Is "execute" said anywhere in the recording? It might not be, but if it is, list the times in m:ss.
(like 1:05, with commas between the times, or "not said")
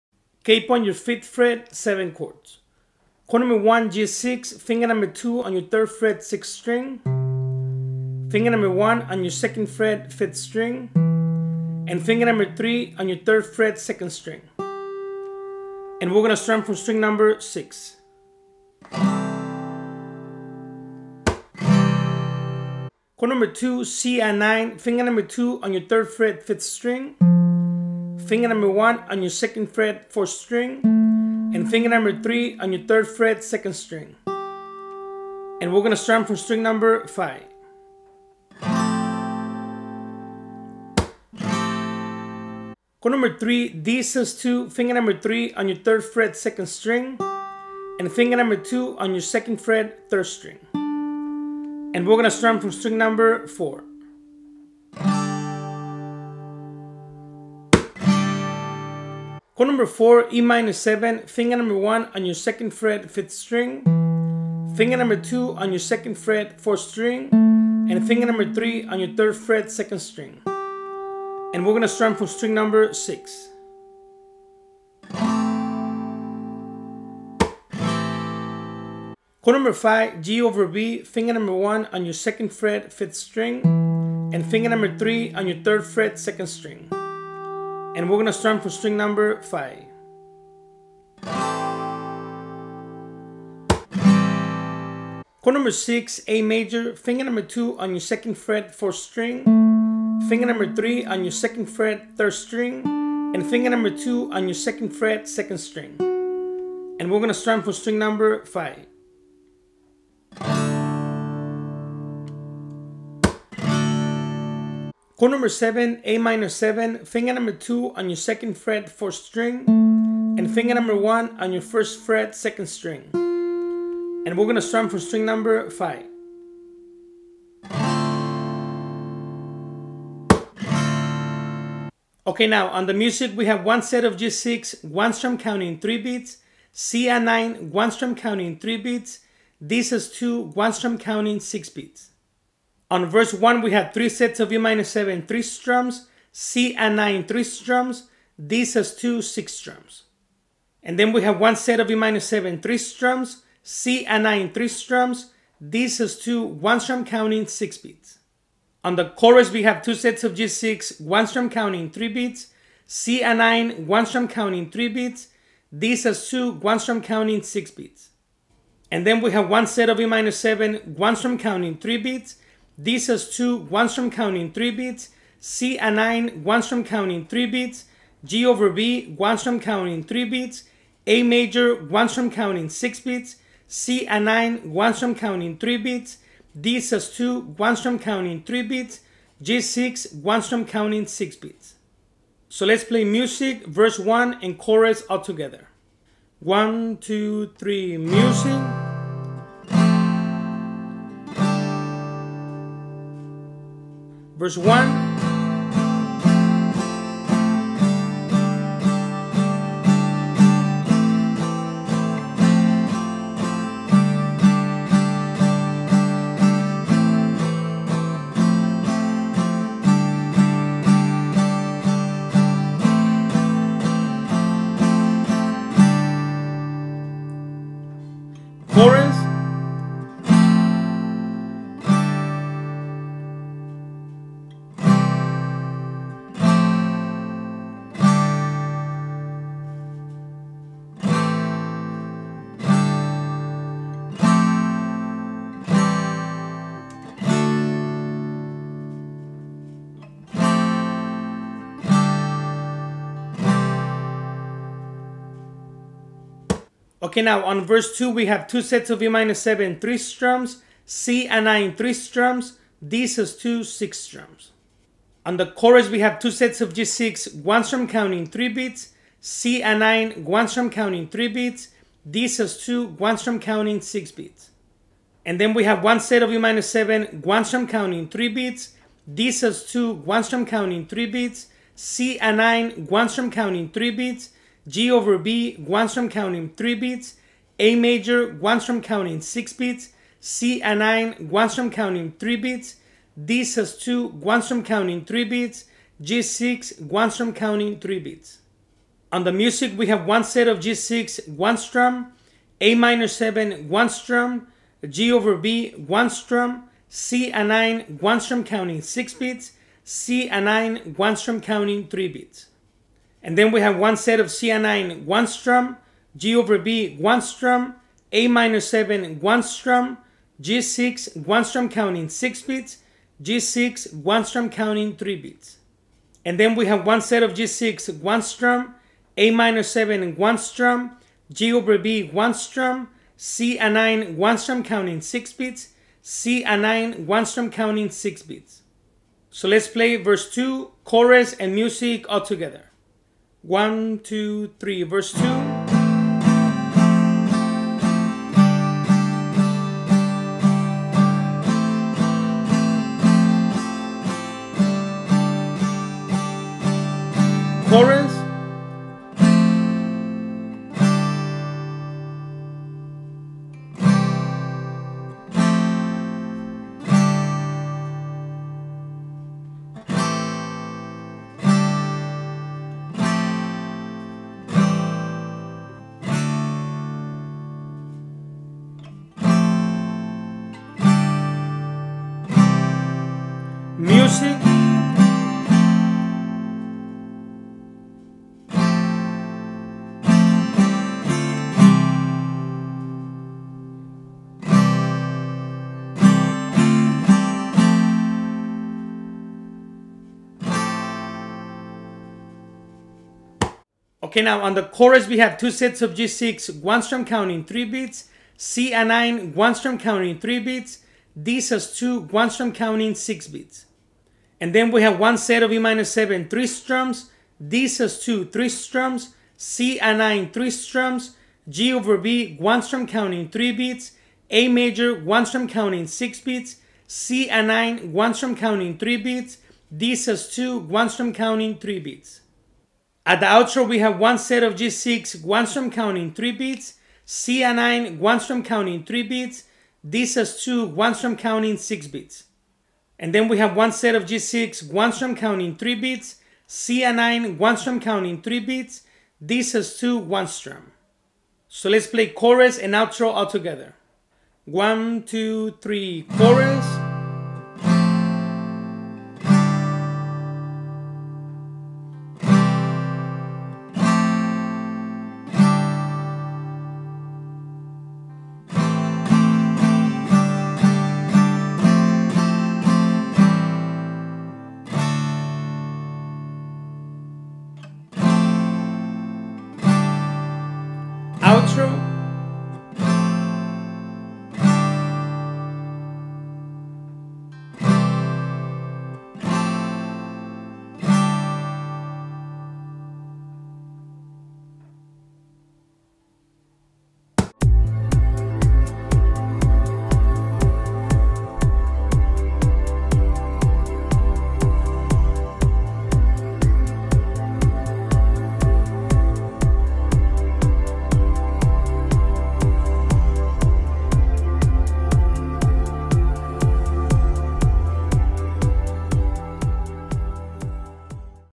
not said.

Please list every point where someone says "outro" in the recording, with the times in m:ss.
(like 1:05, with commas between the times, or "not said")
7:13, 7:32.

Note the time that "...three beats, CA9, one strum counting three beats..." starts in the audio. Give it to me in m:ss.
7:25.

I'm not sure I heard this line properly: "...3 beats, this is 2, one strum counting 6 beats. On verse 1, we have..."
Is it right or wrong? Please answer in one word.
right.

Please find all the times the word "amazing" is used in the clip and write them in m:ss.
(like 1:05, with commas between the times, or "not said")
not said.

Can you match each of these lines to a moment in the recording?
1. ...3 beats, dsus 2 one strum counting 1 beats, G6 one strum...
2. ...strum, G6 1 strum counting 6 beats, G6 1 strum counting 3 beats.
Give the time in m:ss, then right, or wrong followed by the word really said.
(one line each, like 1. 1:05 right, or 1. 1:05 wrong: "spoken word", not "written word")
1. 3:05 wrong: "3", not "1"
2. 5:19 right.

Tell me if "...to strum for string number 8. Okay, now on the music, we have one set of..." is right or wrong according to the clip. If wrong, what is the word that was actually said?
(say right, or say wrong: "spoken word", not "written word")
wrong: "5", not "8".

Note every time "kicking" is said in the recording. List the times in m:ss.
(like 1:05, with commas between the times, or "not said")
not said.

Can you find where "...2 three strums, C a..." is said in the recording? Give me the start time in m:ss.
6:58.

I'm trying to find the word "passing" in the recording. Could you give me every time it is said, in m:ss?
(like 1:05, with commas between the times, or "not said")
not said.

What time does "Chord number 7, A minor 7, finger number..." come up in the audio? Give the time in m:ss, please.
1:55.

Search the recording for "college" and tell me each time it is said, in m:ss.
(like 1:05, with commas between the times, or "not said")
not said.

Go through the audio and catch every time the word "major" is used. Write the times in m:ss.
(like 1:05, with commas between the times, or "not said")
1:36, 3:01, 4:47, 7:04.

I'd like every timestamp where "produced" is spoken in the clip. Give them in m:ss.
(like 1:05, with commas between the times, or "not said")
not said.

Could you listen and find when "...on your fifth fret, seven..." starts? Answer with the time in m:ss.
0:00.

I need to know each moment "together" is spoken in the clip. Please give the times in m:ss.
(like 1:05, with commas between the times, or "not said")
3:15, 5:42, 7:33.